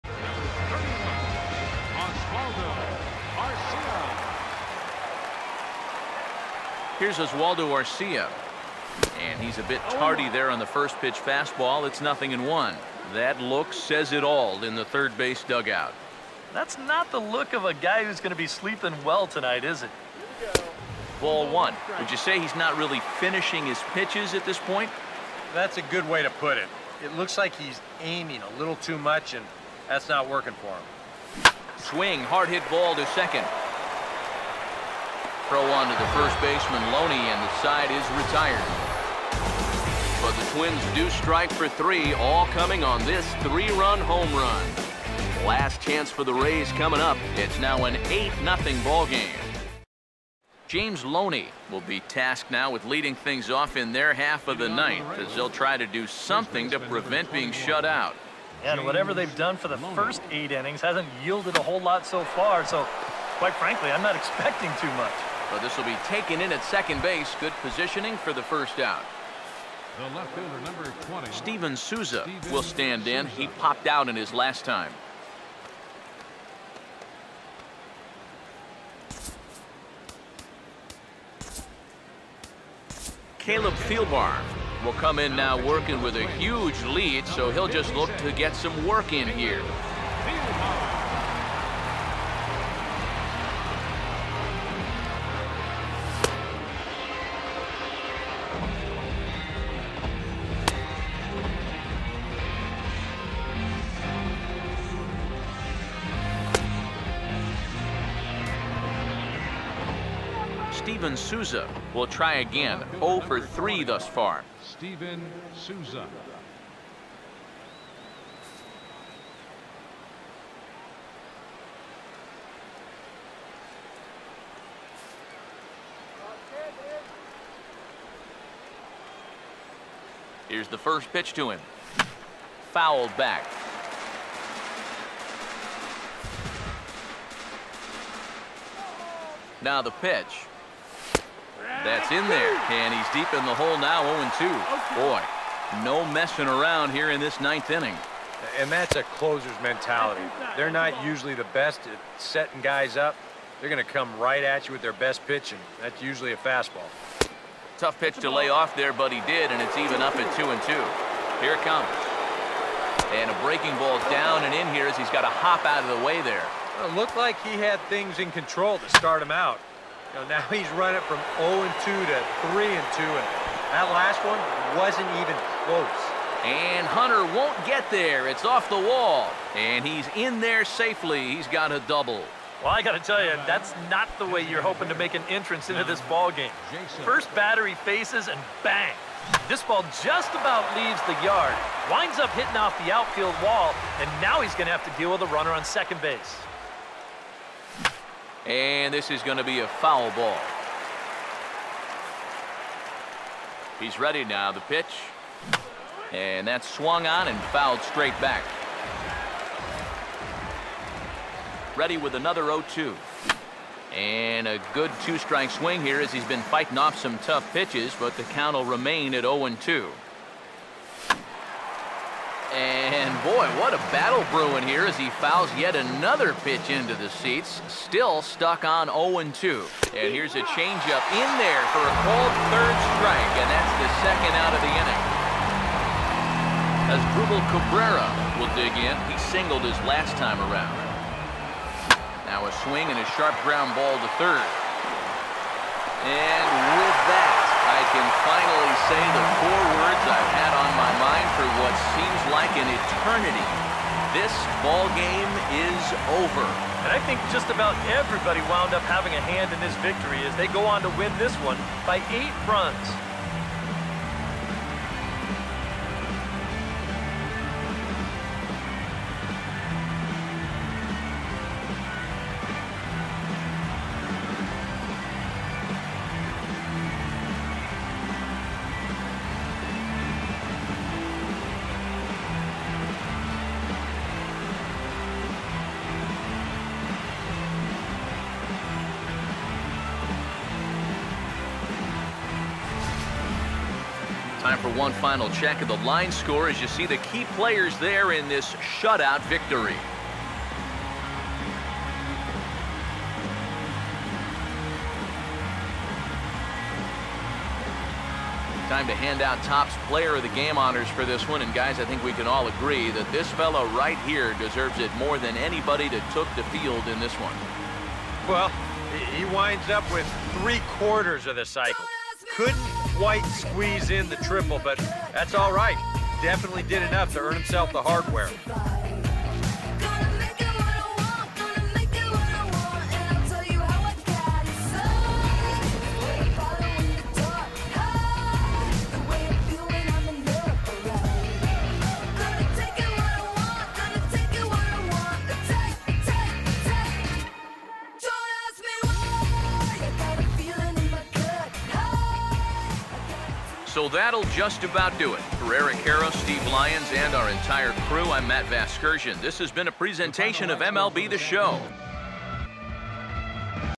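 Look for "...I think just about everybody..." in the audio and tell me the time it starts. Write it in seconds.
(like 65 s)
256 s.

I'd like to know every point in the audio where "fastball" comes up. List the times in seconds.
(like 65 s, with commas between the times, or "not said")
11 s, 156 s.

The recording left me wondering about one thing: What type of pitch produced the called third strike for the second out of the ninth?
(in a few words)
Changeup.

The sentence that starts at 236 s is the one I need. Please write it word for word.
As Asdrubal Cabrera will dig in, he singled his last time around.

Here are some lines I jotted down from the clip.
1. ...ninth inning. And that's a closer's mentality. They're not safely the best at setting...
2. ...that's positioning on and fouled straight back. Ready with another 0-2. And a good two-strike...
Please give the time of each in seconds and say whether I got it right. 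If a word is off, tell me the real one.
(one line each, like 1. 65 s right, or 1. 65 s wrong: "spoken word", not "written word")
1. 147 s wrong: "usually", not "safely"
2. 206 s wrong: "swung", not "positioning".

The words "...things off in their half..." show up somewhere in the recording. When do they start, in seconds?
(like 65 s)
53 s.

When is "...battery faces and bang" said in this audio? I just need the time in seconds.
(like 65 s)
187 s.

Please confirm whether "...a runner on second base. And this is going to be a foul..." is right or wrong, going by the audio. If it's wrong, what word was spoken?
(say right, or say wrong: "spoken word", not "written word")
right.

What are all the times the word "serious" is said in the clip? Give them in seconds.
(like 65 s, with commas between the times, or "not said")
not said.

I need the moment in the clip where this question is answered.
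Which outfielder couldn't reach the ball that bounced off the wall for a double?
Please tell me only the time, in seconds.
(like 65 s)
176 s.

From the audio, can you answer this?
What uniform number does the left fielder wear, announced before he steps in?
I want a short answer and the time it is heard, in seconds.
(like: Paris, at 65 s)
20, at 70 s.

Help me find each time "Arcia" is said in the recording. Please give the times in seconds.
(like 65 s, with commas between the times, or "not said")
7 s.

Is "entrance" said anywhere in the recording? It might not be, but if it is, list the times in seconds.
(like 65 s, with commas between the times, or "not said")
185 s.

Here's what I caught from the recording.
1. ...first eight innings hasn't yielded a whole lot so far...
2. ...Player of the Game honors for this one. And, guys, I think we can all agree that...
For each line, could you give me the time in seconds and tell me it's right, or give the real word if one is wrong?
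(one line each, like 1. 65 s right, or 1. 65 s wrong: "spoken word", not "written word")
1. 59 s right
2. 309 s right.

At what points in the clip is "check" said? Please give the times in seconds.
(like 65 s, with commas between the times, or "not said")
295 s.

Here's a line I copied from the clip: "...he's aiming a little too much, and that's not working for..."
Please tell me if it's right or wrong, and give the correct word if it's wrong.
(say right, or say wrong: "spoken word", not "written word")
right.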